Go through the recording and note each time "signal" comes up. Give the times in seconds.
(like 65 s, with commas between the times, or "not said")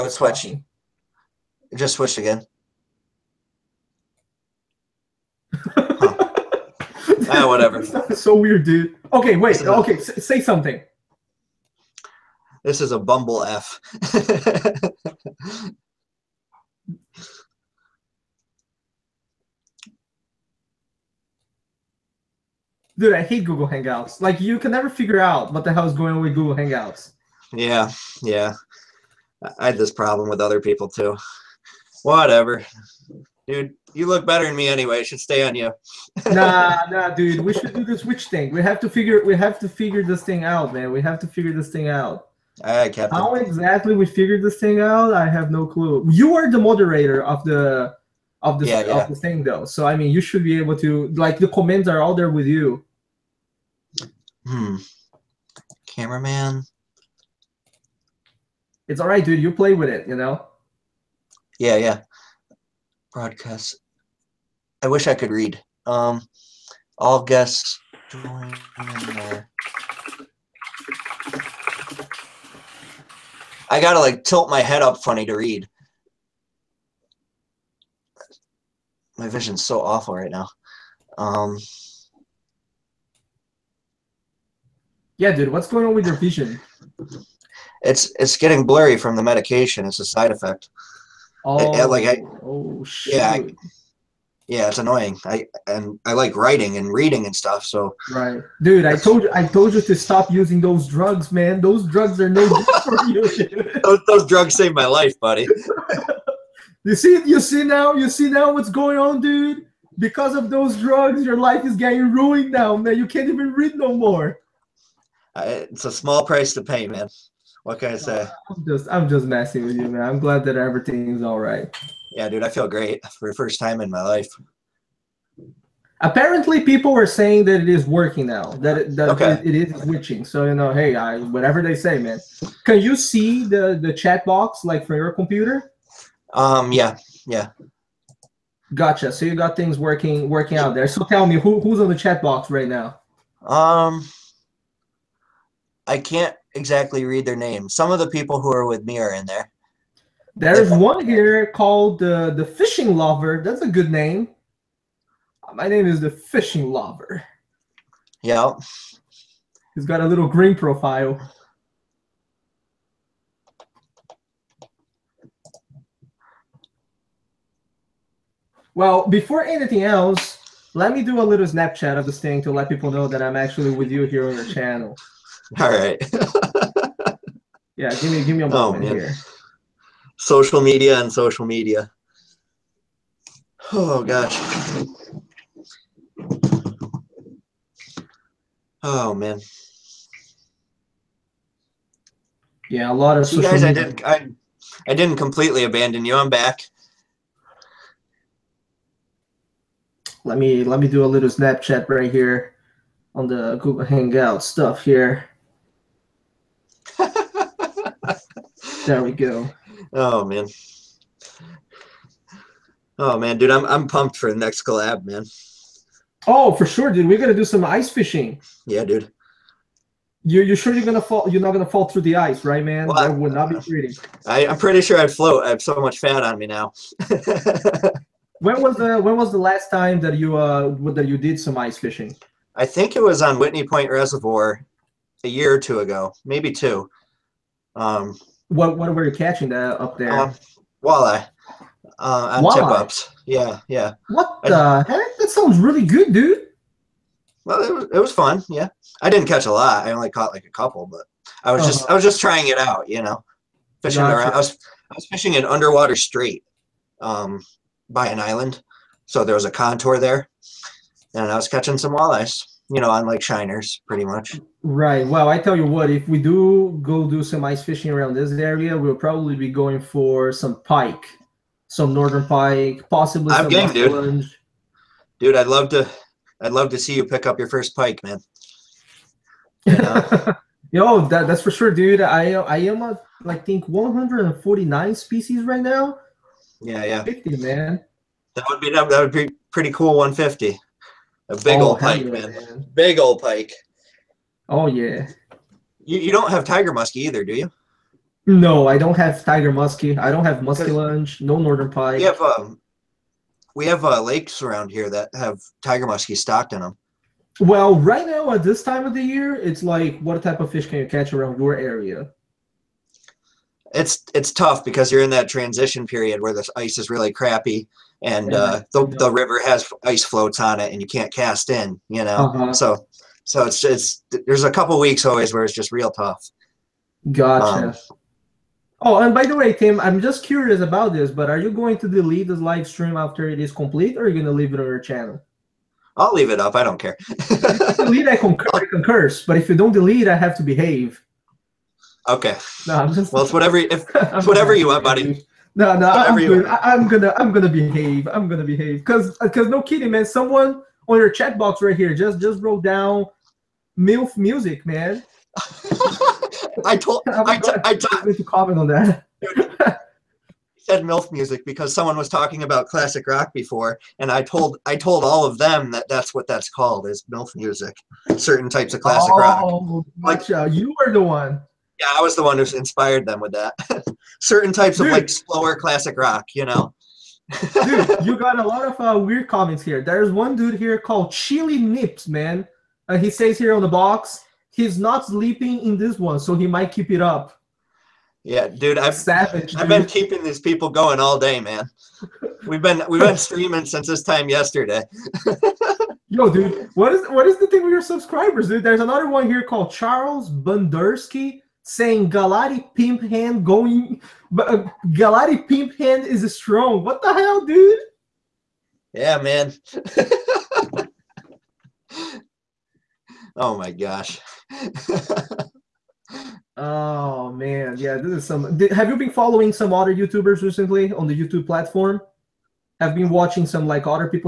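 not said.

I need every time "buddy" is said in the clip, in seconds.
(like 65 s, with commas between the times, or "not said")
105 s, 344 s.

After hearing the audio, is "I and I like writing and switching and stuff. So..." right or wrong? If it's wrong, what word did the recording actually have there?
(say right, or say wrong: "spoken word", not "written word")
wrong: "reading", not "switching".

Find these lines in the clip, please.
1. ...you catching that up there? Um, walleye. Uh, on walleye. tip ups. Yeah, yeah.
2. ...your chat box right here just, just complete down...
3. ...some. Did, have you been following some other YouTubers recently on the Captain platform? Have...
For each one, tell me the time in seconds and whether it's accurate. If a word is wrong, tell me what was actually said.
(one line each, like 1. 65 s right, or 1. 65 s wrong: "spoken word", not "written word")
1. 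239 s right
2. 350 s wrong: "wrote", not "complete"
3. 418 s wrong: "YouTube", not "Captain".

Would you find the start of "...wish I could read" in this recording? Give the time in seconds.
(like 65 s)
64 s.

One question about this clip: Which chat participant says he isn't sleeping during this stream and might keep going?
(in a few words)
Chili Nips.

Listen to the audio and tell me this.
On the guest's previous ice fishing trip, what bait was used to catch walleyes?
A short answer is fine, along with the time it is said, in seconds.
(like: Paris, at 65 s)
shiners, at 263 s.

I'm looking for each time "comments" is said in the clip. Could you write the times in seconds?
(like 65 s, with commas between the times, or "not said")
51 s, 358 s, 379 s.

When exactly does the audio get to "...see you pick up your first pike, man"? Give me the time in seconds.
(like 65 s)
276 s.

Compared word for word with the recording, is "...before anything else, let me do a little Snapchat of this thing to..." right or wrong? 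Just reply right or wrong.
right.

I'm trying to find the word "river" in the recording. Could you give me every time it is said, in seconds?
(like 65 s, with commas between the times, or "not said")
319 s.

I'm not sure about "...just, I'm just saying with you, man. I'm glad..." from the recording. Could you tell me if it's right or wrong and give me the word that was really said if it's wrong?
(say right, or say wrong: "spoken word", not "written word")
wrong: "messing", not "saying".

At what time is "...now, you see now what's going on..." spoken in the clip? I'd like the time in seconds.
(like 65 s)
107 s.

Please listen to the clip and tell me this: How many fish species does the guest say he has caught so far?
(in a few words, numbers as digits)
149.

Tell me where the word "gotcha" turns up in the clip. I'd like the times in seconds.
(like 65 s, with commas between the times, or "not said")
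138 s, 254 s, 327 s, 370 s.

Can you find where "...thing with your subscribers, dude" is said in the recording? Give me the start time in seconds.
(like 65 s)
397 s.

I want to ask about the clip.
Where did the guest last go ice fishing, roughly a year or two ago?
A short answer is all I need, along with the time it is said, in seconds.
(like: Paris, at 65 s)
Whitney Point Reservoir, at 233 s.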